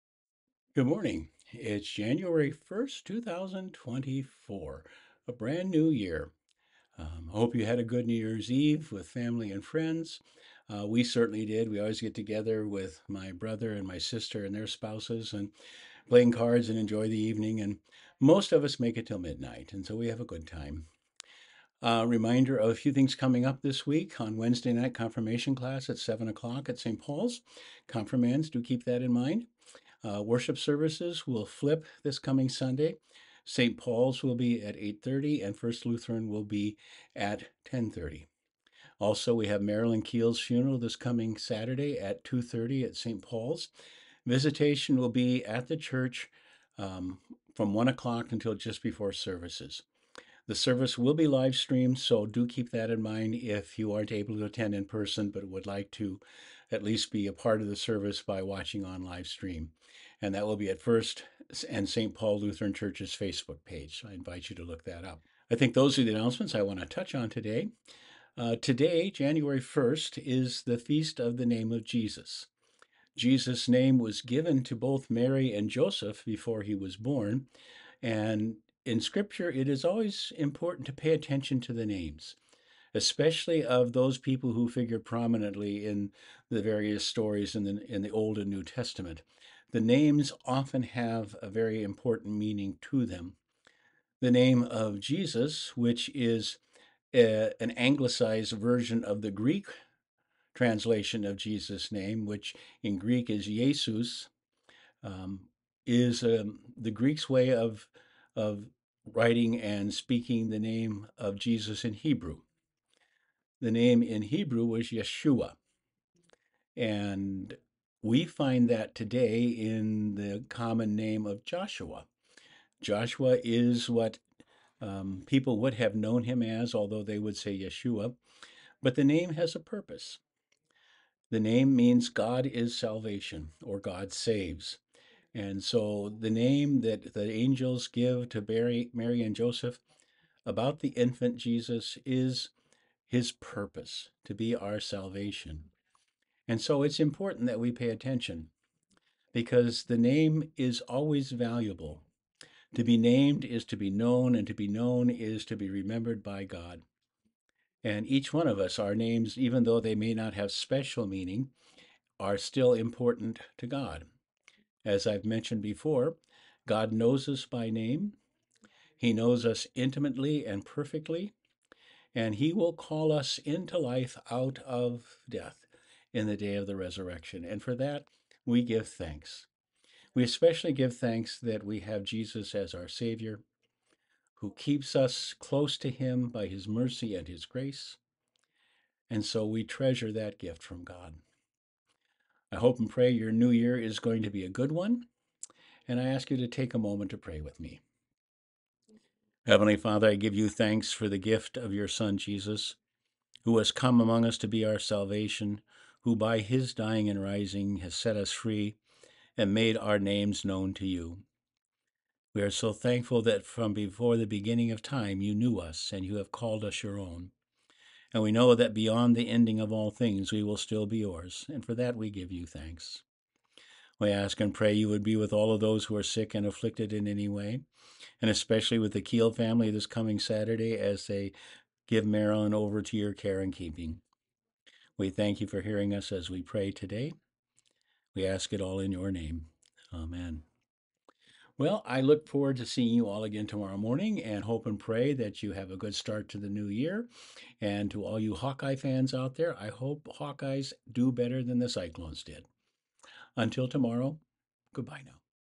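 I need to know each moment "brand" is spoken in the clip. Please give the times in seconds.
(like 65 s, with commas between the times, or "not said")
5 s.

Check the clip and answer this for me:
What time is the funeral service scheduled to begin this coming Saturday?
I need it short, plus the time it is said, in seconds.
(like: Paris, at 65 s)
2:30, at 42 s.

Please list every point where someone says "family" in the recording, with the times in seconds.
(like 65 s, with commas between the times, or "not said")
9 s, 229 s.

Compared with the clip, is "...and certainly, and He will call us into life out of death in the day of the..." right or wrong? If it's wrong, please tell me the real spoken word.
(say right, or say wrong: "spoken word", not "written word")
wrong: "perfectly", not "certainly".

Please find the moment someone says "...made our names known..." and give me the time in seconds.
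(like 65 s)
209 s.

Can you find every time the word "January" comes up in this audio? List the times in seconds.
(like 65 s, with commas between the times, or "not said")
1 s, 69 s.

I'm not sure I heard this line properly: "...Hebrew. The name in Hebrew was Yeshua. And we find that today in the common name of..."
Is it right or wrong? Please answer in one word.
right.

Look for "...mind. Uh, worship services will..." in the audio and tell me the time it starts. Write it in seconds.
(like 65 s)
29 s.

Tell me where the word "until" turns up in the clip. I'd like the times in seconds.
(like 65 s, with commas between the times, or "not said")
48 s, 253 s.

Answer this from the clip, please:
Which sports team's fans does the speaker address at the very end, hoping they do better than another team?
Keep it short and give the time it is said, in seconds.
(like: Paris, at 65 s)
Hawkeyes, at 248 s.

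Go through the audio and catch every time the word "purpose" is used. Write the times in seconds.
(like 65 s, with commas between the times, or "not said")
129 s, 143 s.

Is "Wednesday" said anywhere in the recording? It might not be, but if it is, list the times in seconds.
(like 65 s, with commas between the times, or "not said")
24 s.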